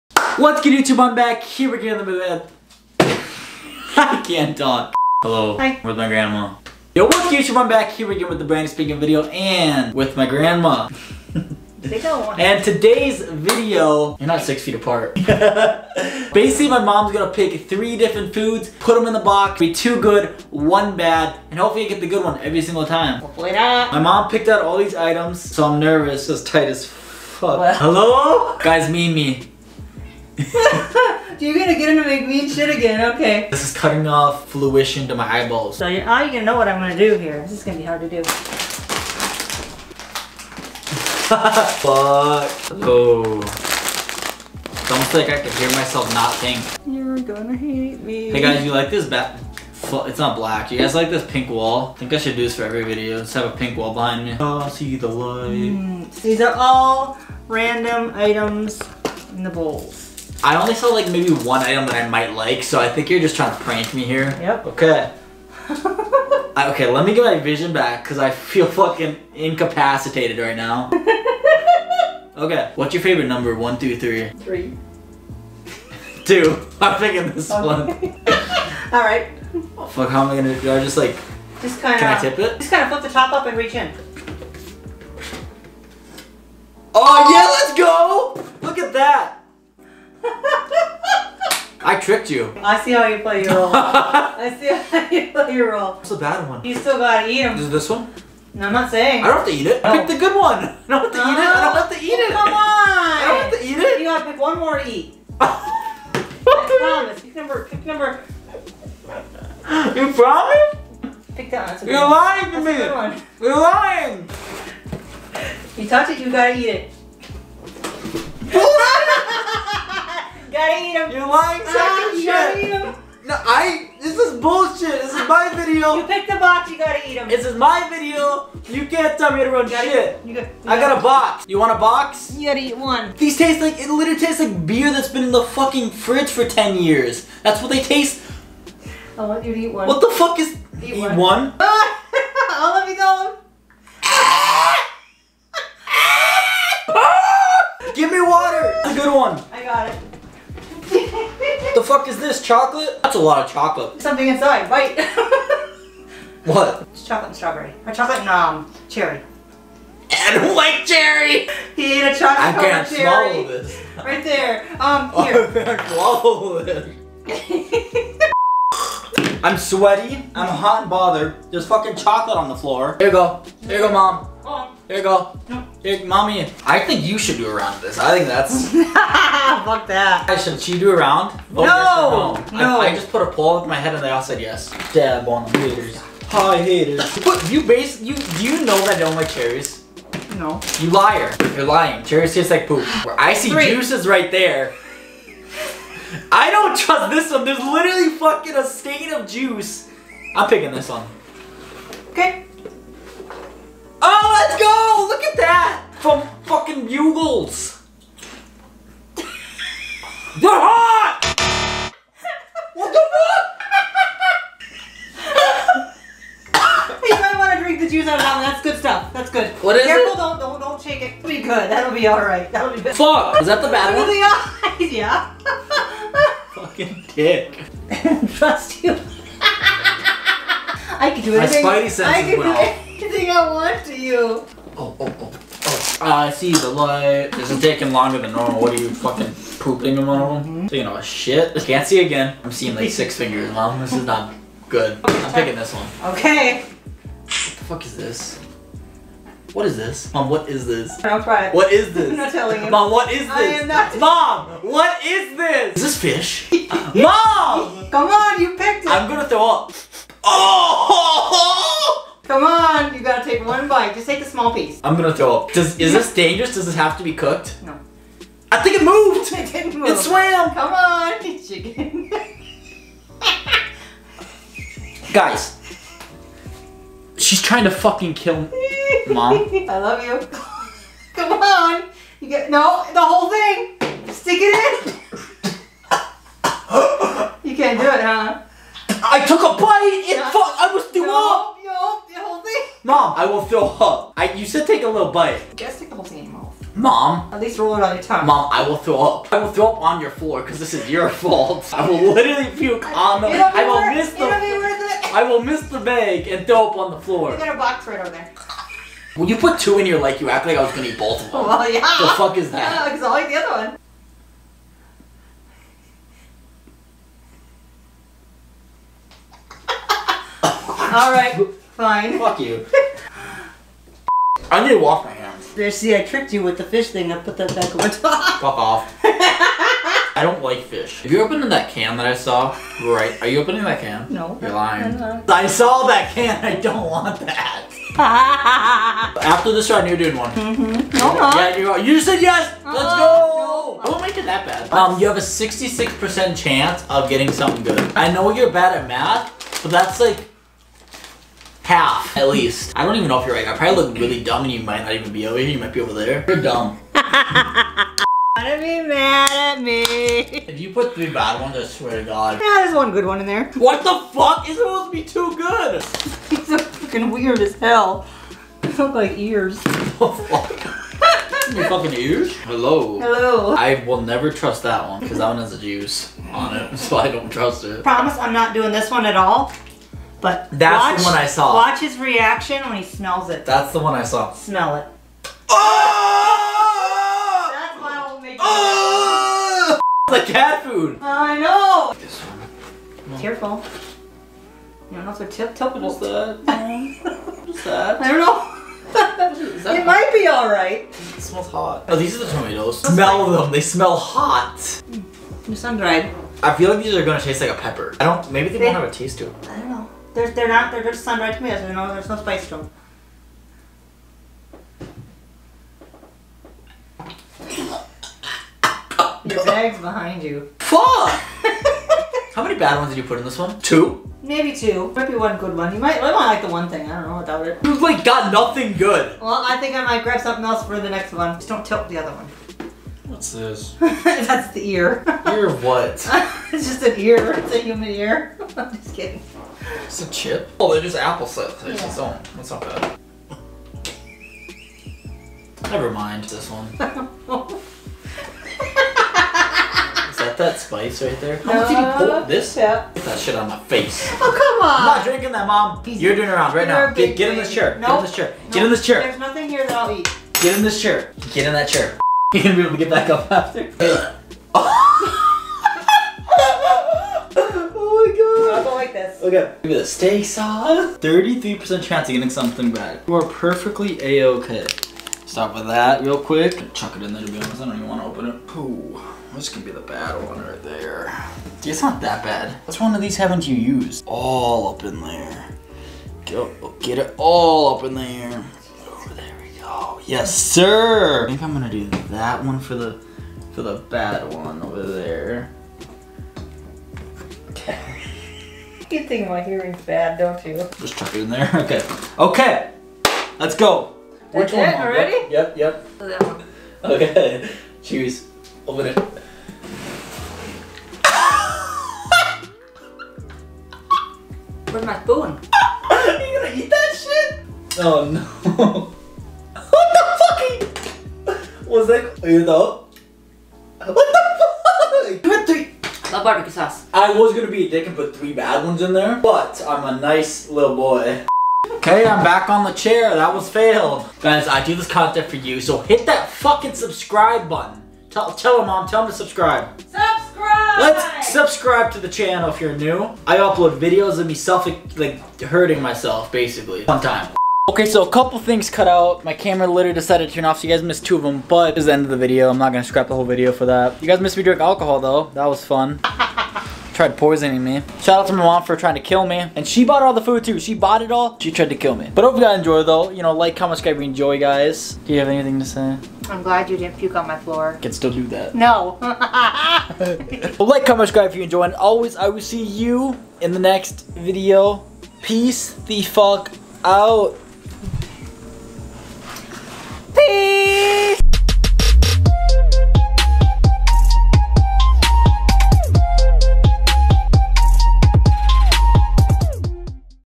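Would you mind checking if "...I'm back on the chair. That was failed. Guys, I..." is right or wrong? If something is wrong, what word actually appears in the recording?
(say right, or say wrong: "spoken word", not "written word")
right.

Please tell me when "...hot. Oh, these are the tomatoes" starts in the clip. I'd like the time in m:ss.
6:41.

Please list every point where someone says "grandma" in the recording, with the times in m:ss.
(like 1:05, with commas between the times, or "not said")
0:06, 0:10.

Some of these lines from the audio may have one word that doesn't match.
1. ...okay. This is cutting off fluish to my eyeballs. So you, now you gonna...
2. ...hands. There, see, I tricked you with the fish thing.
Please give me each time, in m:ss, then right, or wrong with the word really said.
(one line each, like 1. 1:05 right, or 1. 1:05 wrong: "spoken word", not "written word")
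1. 0:33 right
2. 5:25 right.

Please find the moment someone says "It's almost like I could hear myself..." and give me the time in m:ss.
0:43.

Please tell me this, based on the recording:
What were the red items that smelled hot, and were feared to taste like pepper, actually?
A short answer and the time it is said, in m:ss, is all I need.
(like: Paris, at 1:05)
Sun dried tomatoes, at 6:51.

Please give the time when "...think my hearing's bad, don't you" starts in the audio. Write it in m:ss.
8:19.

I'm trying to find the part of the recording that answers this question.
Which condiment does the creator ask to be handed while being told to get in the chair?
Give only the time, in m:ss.
7:49.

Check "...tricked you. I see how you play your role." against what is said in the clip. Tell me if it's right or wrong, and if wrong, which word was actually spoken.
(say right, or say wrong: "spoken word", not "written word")
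right.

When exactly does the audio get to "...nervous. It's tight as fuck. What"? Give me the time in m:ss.
0:25.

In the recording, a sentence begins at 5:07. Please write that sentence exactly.
You got a box right over there.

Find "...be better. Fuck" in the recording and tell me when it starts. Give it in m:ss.
3:42.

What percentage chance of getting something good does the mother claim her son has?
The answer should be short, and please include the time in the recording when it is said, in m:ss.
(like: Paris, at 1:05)
66%, at 5:45.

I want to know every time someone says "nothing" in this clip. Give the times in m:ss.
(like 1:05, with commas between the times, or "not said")
7:08, 7:39.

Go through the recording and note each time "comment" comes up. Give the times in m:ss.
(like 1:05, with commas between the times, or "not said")
9:23, 9:30.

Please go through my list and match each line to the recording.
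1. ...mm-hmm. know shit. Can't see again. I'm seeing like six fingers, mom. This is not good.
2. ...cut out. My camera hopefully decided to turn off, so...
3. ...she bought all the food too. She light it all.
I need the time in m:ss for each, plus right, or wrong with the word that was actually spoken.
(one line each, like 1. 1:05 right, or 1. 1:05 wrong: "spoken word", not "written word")
1. 4:00 right
2. 9:08 wrong: "literally", not "hopefully"
3. 9:19 wrong: "bought", not "light".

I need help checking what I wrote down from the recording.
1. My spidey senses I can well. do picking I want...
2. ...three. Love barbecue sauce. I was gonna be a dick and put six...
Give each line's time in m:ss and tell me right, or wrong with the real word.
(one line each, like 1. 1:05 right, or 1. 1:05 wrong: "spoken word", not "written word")
1. 3:51 wrong: "anything", not "picking"
2. 8:45 wrong: "three", not "six".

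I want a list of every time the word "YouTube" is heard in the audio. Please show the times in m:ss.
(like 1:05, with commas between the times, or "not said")
0:00, 0:07.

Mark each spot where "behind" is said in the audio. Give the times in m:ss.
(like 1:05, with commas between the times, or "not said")
0:53, 6:59.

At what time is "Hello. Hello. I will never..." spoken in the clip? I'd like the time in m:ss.
6:12.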